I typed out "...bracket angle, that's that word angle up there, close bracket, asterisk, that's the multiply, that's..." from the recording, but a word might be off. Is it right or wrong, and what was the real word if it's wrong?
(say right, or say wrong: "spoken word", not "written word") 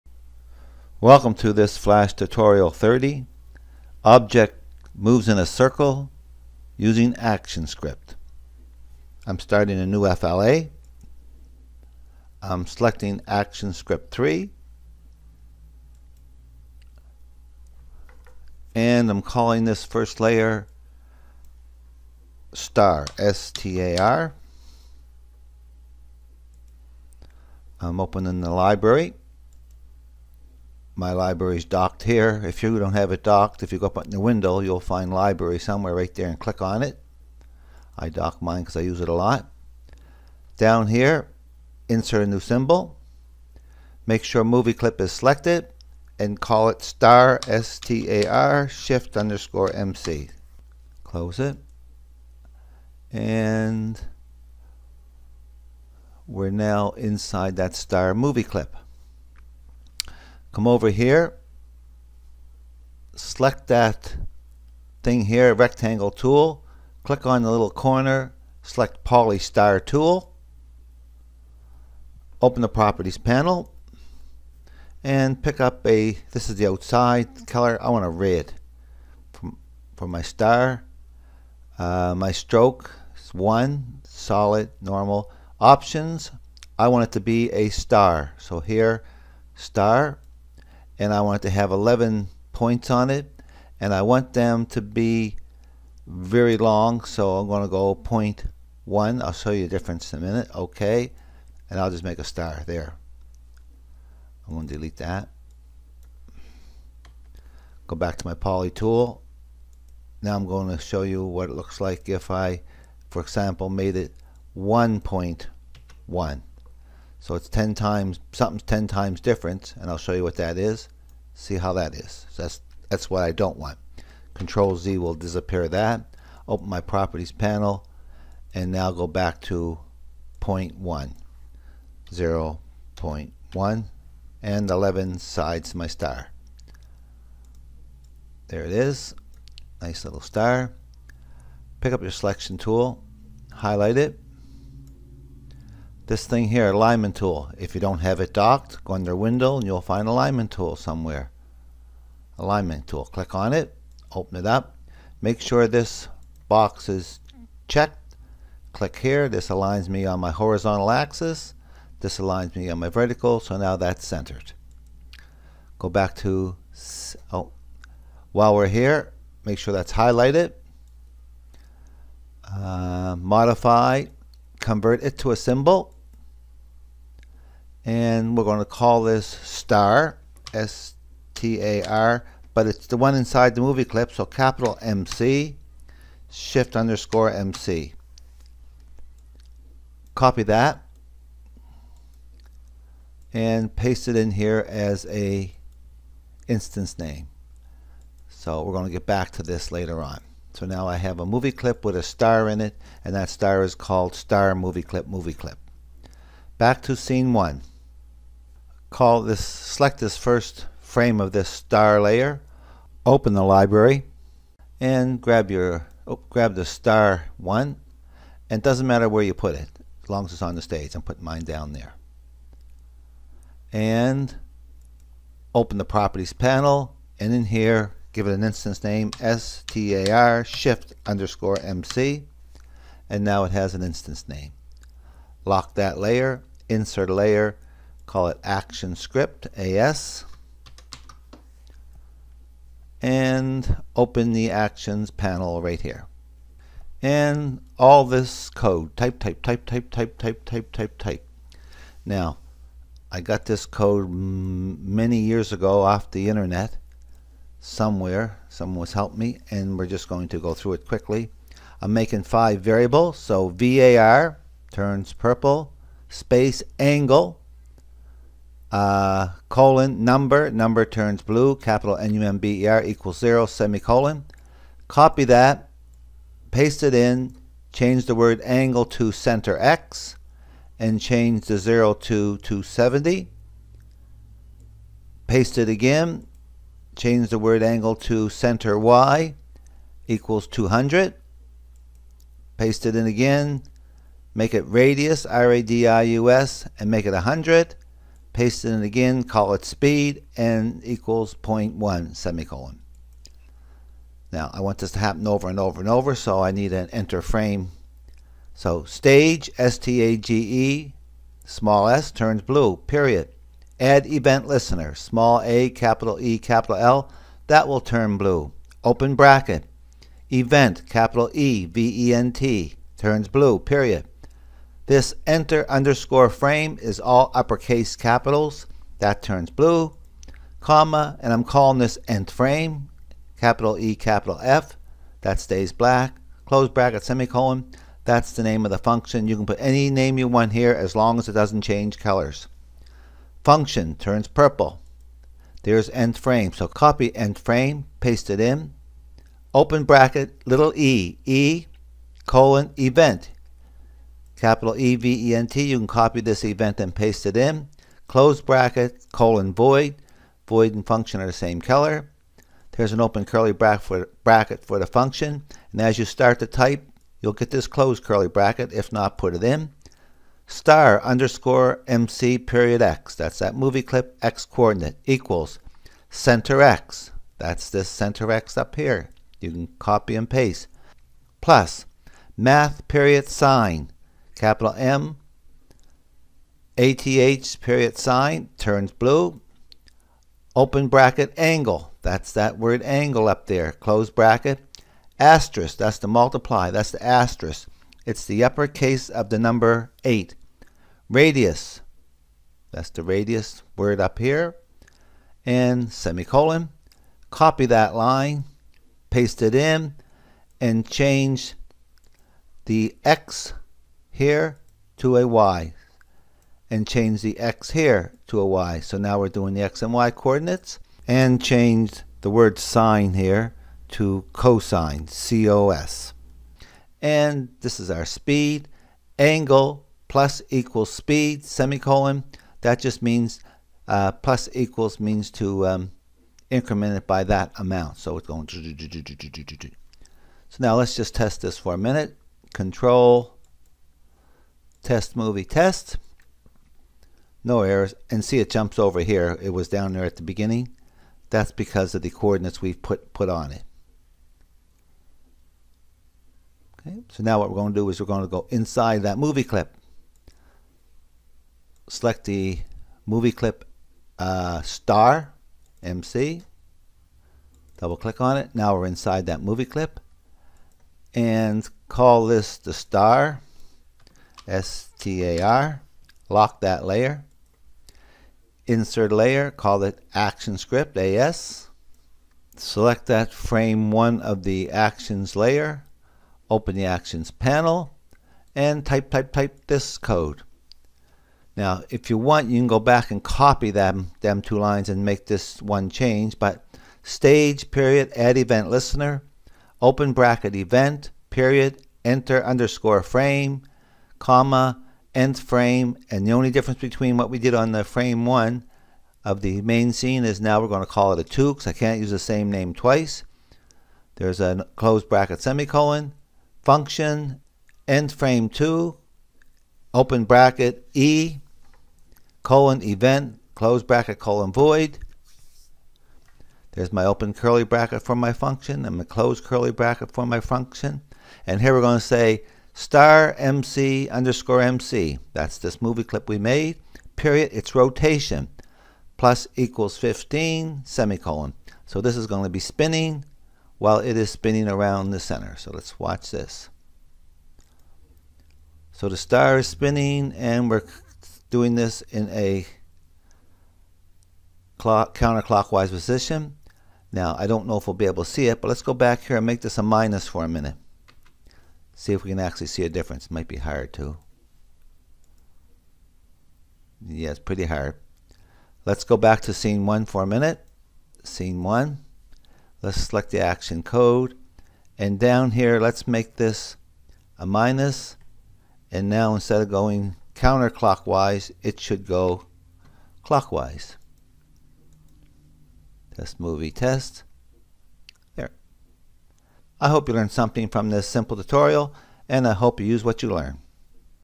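right.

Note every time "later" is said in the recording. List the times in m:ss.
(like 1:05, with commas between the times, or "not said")
3:19.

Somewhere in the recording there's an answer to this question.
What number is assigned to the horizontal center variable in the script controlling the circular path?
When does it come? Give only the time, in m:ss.
4:42.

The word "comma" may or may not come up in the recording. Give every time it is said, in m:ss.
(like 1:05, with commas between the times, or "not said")
5:30, 8:24.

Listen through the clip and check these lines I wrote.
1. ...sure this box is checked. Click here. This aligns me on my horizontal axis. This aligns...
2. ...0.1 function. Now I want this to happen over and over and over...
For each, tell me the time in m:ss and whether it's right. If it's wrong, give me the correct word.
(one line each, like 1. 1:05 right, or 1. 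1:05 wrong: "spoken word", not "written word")
1. 2:35 right
2. 5:01 wrong: "semicolon", not "function".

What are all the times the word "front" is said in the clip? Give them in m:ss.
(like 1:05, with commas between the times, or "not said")
not said.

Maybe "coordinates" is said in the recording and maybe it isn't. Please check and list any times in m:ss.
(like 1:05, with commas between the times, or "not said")
6:14, 7:00, 7:32.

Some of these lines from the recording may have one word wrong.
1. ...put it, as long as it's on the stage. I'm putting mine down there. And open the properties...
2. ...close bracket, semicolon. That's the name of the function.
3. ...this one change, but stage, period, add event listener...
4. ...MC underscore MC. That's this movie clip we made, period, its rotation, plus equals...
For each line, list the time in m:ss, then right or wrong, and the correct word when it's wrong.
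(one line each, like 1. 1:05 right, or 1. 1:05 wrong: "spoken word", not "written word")
1. 3:39 right
2. 5:36 right
3. 8:15 right
4. 8:53 right.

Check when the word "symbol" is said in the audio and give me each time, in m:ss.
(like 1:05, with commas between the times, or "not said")
0:42, 2:55.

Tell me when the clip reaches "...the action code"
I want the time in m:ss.
9:33.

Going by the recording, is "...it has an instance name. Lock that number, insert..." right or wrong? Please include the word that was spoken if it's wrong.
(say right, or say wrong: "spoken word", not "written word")
wrong: "layer", not "number".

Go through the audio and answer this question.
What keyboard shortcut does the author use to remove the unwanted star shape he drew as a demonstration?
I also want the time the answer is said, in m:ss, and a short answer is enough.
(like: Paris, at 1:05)
Control Z, at 2:04.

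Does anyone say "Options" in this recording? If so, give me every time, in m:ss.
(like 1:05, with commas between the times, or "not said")
1:25.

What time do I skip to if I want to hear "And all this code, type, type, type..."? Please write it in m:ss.
4:07.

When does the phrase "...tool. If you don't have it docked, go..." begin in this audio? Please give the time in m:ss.
2:27.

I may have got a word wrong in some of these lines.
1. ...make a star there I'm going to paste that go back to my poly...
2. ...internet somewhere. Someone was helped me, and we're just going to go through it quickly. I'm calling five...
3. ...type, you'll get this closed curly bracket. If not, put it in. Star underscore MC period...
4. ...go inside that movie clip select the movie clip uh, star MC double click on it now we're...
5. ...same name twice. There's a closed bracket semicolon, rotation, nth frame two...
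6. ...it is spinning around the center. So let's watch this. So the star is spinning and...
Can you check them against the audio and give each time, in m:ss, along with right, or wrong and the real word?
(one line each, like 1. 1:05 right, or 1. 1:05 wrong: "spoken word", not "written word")
1. 1:42 wrong: "delete", not "paste"
2. 4:16 wrong: "making", not "calling"
3. 6:06 right
4. 7:38 right
5. 8:32 wrong: "function", not "rotation"
6. 9:03 right.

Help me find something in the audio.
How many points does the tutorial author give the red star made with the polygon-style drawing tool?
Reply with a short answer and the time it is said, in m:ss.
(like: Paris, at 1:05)
11, at 1:31.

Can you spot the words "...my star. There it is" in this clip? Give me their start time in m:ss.
2:15.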